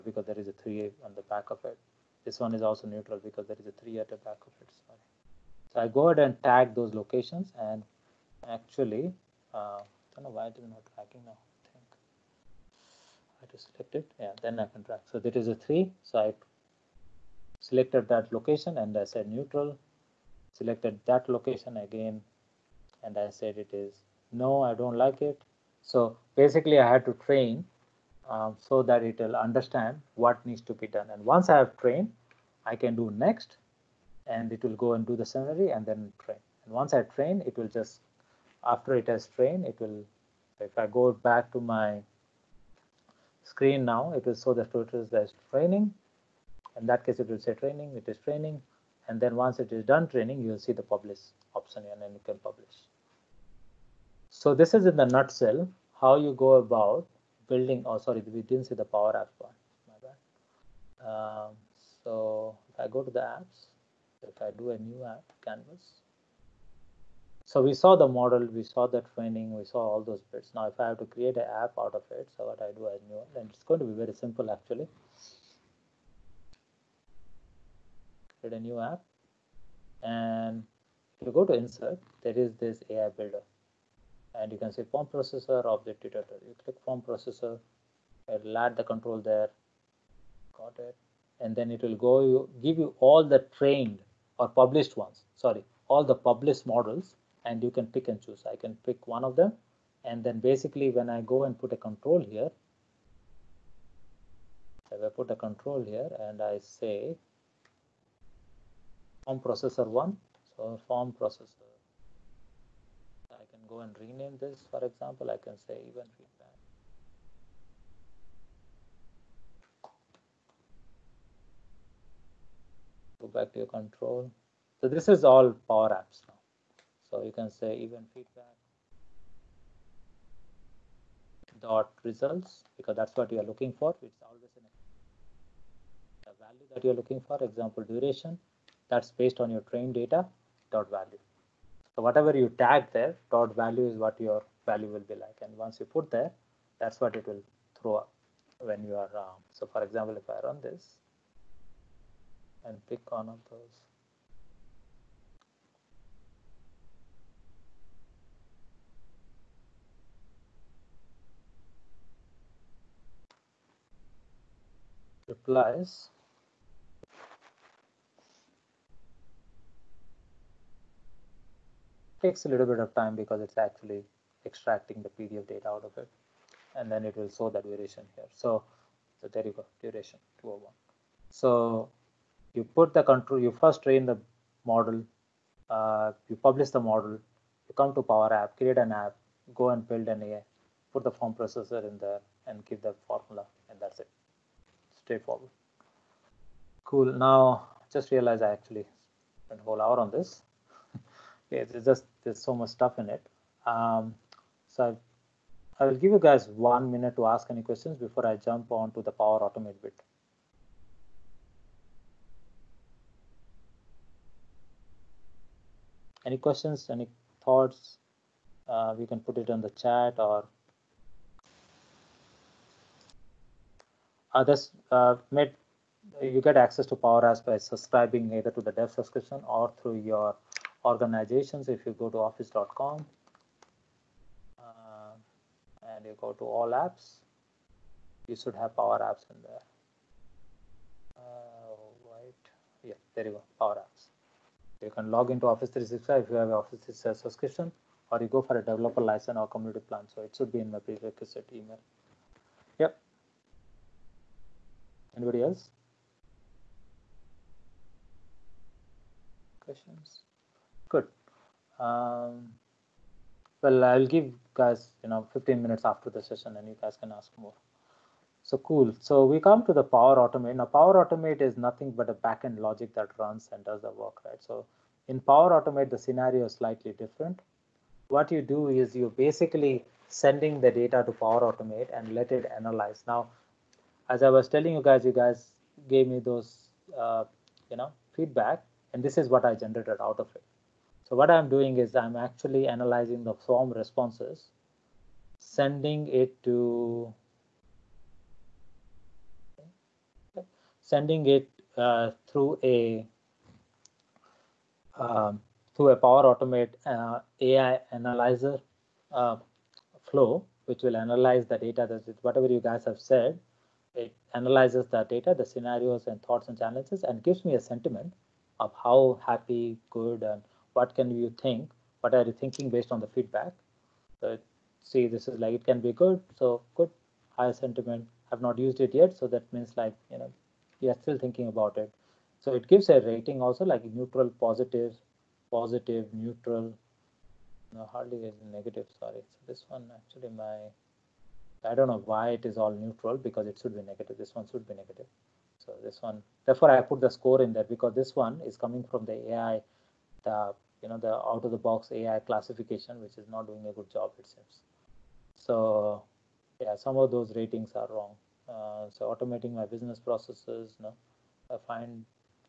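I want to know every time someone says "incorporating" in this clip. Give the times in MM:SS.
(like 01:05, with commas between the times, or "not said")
not said.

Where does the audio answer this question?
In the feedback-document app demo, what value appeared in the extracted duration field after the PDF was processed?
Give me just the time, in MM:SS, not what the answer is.
02:59.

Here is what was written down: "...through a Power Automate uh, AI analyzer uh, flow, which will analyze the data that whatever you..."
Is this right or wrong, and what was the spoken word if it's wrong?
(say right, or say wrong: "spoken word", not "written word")
right.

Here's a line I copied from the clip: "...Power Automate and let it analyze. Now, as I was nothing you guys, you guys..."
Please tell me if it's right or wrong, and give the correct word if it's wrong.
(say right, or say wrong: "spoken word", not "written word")
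wrong: "telling", not "nothing".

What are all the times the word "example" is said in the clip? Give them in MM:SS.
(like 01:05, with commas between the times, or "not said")
01:54, 02:17, 02:29.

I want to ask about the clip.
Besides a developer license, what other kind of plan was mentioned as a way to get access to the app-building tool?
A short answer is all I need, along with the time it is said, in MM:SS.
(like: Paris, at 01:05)
community plan, at 04:09.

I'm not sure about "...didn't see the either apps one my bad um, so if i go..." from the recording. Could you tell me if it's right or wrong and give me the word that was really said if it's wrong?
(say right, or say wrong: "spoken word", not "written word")
wrong: "power", not "either".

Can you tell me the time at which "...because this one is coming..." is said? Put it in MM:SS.
05:47.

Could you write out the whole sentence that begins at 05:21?
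What are you thinking based on the feedback?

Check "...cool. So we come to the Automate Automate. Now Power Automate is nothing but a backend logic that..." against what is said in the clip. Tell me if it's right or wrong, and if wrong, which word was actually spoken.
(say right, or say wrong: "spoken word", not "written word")
wrong: "Power", not "Automate".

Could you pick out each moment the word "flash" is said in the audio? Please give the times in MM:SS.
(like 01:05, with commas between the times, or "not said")
not said.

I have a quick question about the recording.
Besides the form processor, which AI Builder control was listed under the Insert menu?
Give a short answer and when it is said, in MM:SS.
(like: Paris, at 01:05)
object detector, at 01:25.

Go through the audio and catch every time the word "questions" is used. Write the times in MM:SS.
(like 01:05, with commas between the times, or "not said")
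03:27, 03:36, 04:19.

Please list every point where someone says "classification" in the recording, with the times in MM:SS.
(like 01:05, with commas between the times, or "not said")
05:52.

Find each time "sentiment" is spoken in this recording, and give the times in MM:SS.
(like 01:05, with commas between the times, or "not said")
05:17, 05:27.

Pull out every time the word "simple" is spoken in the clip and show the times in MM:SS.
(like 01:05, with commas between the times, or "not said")
01:14.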